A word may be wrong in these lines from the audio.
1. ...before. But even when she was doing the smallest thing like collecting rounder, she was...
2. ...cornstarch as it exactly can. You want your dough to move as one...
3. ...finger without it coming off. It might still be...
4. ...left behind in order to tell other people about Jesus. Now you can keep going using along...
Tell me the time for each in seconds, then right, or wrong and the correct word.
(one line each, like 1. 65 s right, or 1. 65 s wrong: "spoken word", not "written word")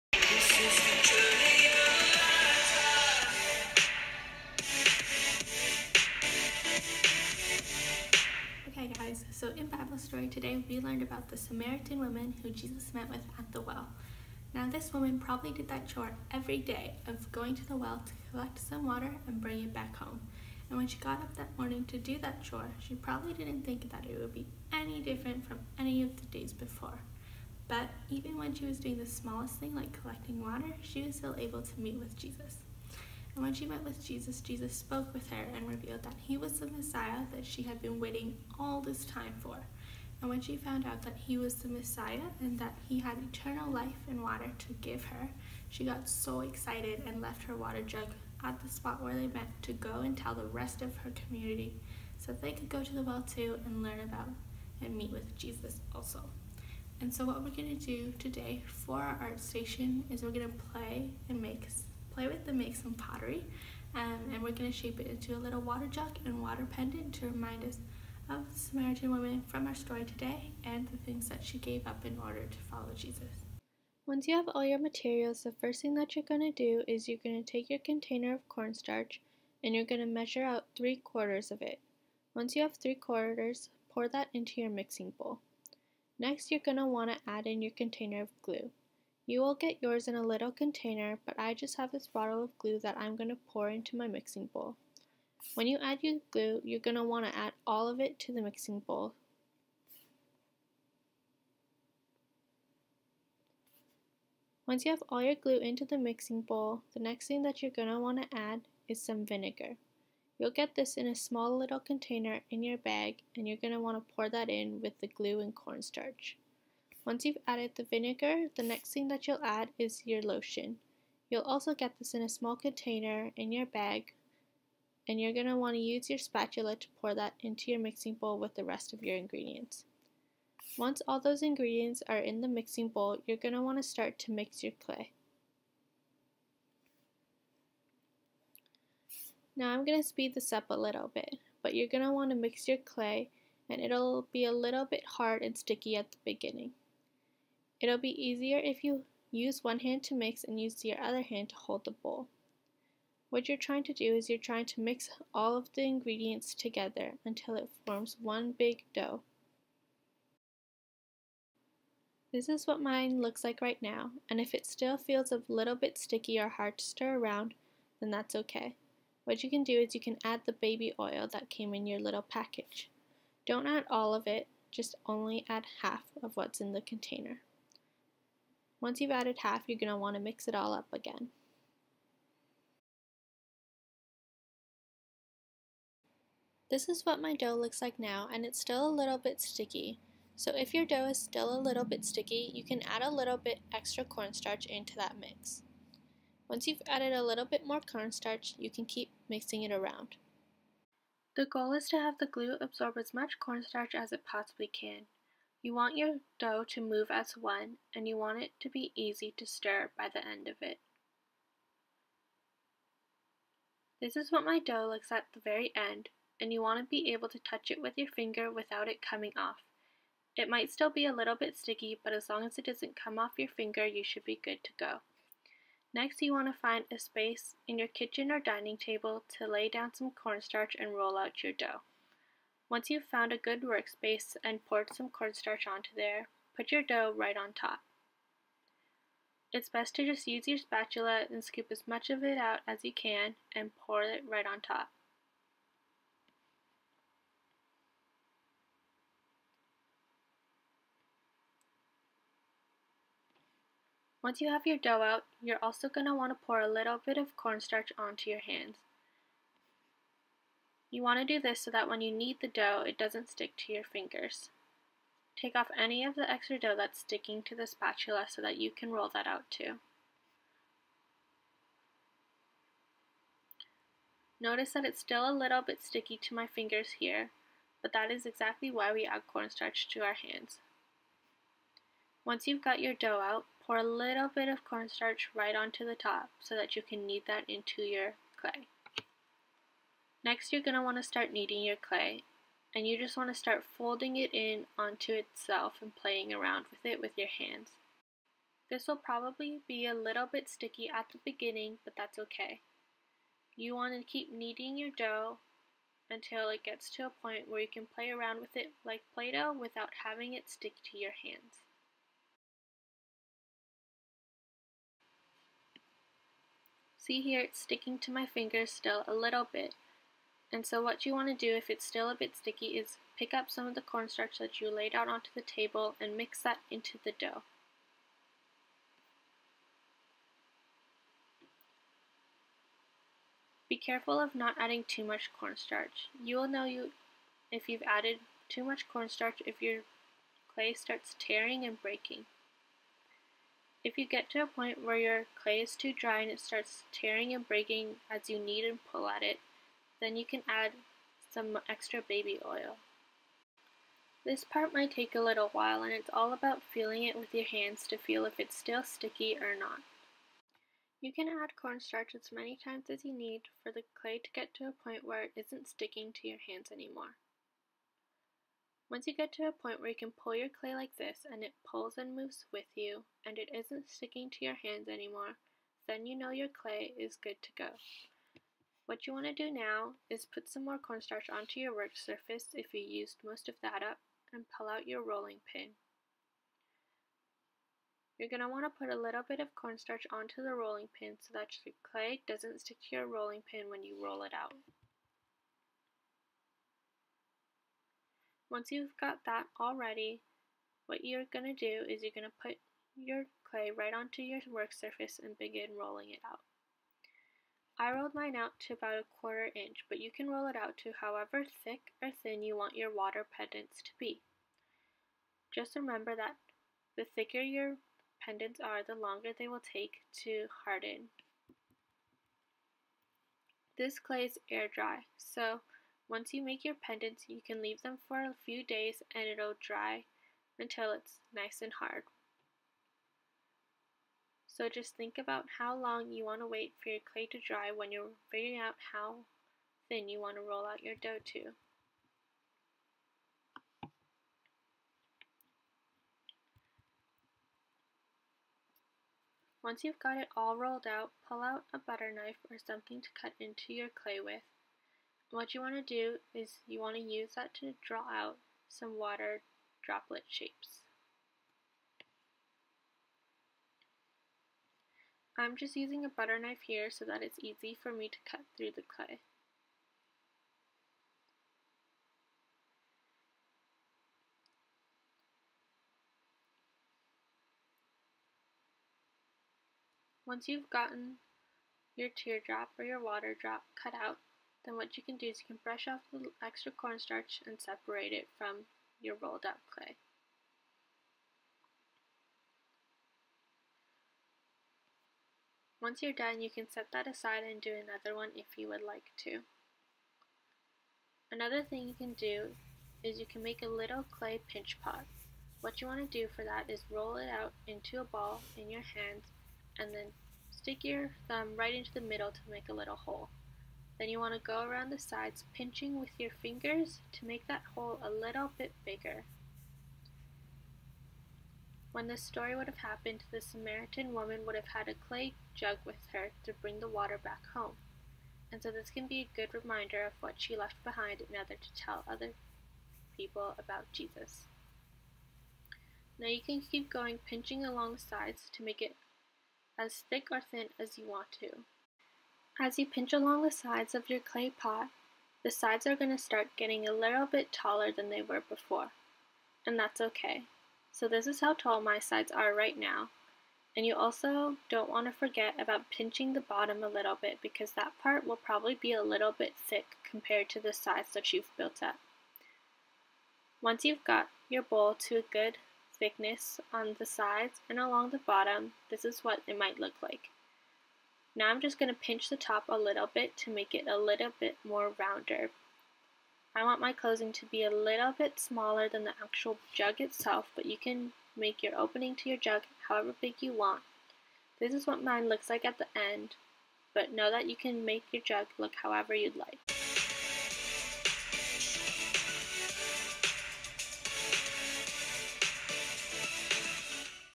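1. 26 s wrong: "water", not "rounder"
2. 203 s wrong: "possibly", not "exactly"
3. 218 s right
4. 530 s wrong: "pinching", not "using".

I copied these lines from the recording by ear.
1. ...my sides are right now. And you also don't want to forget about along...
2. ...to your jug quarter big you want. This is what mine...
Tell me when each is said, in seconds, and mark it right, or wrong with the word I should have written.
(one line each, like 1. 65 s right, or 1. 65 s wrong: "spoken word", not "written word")
1. 551 s wrong: "pinching", not "along"
2. 582 s wrong: "however", not "quarter".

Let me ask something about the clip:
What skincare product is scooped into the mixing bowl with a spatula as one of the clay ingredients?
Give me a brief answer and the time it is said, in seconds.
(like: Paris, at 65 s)
Lotion, at 120 s.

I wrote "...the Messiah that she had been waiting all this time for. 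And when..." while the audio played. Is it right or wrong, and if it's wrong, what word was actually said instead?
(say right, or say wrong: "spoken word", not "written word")
right.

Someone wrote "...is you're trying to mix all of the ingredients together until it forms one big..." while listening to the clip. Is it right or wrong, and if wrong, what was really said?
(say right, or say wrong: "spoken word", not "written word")
right.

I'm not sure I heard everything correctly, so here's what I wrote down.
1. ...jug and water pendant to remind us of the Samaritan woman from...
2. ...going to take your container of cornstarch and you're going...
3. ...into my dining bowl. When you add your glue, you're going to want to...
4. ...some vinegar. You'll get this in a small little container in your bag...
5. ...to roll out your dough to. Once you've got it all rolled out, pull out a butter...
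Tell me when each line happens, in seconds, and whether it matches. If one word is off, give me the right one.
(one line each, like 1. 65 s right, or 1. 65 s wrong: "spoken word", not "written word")
1. 65 s right
2. 77 s right
3. 93 s wrong: "mixing", not "dining"
4. 109 s right
5. 440 s right.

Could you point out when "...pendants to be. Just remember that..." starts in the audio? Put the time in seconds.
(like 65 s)
413 s.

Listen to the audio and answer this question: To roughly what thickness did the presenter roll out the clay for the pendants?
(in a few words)
A quarter inch.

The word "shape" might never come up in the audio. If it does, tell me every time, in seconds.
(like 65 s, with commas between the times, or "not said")
64 s, 460 s.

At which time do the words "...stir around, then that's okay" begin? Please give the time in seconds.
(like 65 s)
166 s.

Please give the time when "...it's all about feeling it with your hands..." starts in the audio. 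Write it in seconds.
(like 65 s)
355 s.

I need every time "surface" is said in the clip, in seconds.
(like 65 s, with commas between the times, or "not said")
381 s, 404 s.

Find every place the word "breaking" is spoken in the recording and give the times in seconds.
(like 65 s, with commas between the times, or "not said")
341 s, 347 s.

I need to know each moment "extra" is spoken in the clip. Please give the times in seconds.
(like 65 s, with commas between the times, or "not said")
193 s, 266 s, 351 s, 486 s.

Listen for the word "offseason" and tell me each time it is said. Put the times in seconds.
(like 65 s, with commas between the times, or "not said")
not said.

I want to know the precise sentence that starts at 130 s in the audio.
Once all those ingredients are in the mixing bowl, you're going to want to start to mix your clay.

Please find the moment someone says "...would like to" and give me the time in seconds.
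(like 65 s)
498 s.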